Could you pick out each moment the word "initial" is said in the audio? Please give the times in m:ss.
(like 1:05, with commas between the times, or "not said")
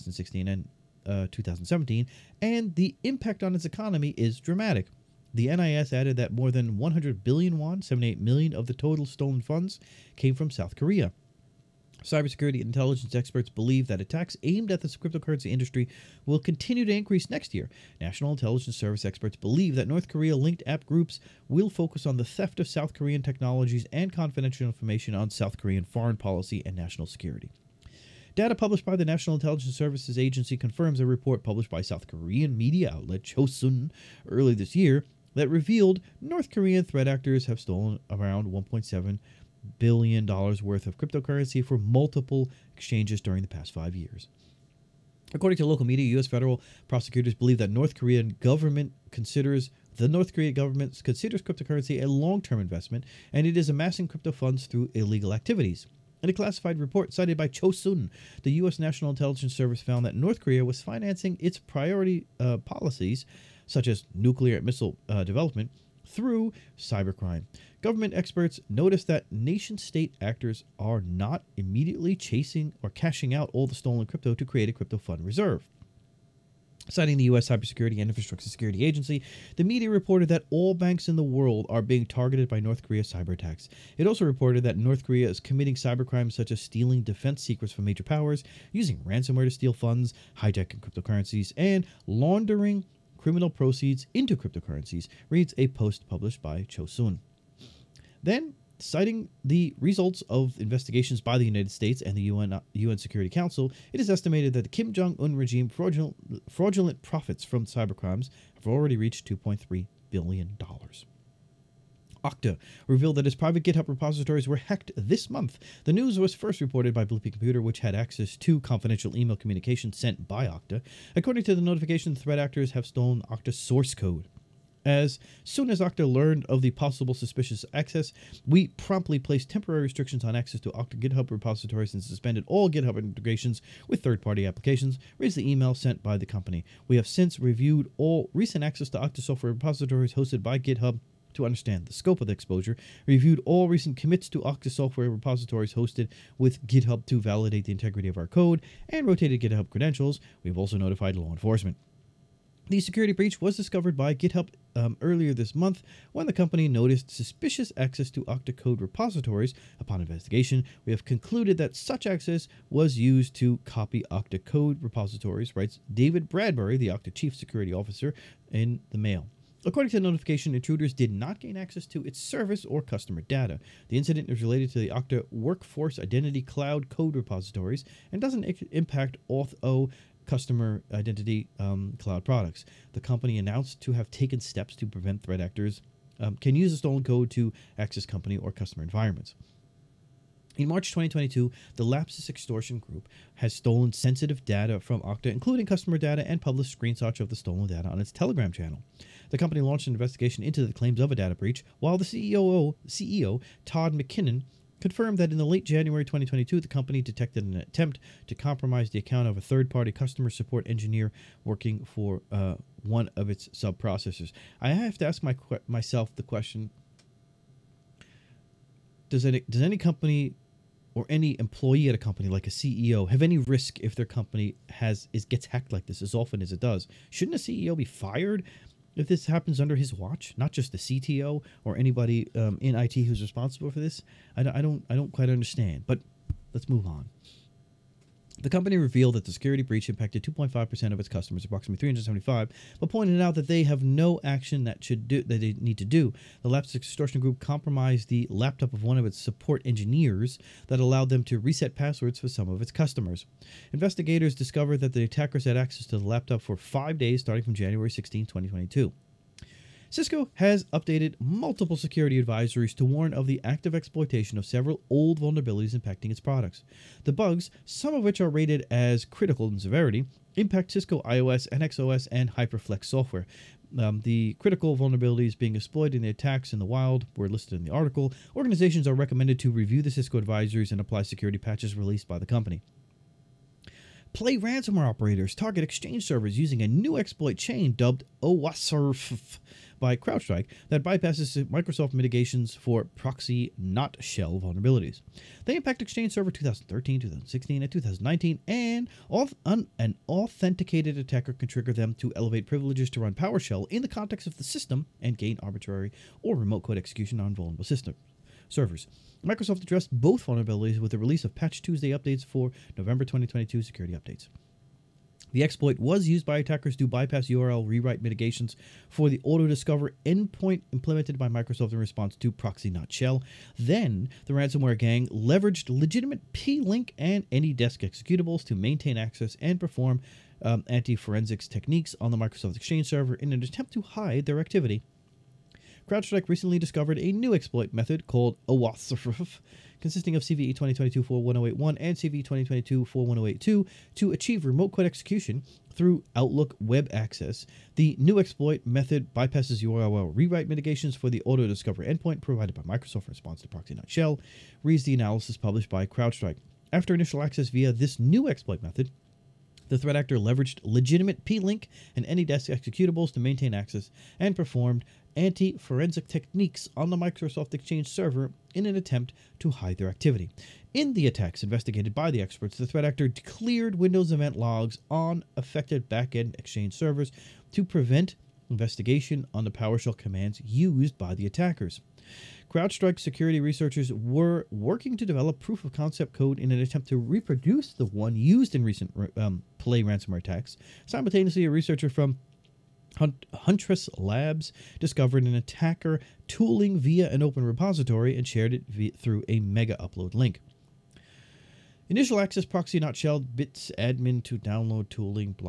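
5:56, 6:41.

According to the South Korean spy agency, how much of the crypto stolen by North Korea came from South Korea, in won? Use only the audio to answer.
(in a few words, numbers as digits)
more than 100 billion won.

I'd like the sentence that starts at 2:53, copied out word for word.
The incident is related to the Okta Workforce Identity Cloud code repositories and doesn't impact Auth0 customer identity um, cloud products.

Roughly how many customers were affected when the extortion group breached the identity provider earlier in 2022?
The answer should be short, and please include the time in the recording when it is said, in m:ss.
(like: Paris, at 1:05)
375, at 4:01.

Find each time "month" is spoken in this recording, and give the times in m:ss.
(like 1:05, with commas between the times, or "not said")
1:55, 2:35.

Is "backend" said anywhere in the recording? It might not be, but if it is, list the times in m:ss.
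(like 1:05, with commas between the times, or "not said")
6:15.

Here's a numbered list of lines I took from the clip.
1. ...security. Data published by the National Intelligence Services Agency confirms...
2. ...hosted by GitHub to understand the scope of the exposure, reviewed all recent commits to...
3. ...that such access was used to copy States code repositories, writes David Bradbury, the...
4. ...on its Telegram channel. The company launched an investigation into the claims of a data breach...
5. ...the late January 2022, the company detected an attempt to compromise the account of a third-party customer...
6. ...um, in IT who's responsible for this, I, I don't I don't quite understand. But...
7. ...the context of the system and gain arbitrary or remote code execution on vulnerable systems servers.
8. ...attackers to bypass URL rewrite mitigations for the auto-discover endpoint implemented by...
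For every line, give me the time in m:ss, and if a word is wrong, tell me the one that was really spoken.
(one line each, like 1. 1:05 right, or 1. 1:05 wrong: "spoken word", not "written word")
1. 0:27 right
2. 2:20 right
3. 2:41 wrong: "Okta", not "States"
4. 3:17 right
5. 3:25 right
6. 3:52 right
7. 5:03 right
8. 5:16 right.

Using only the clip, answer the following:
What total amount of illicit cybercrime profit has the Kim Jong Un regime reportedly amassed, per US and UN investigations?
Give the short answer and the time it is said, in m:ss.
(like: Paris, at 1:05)
$2.3 billion, at 1:49.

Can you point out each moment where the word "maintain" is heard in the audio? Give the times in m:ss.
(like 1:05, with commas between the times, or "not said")
5:28, 6:03.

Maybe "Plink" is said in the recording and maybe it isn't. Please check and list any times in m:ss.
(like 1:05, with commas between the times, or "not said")
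5:26, 6:01.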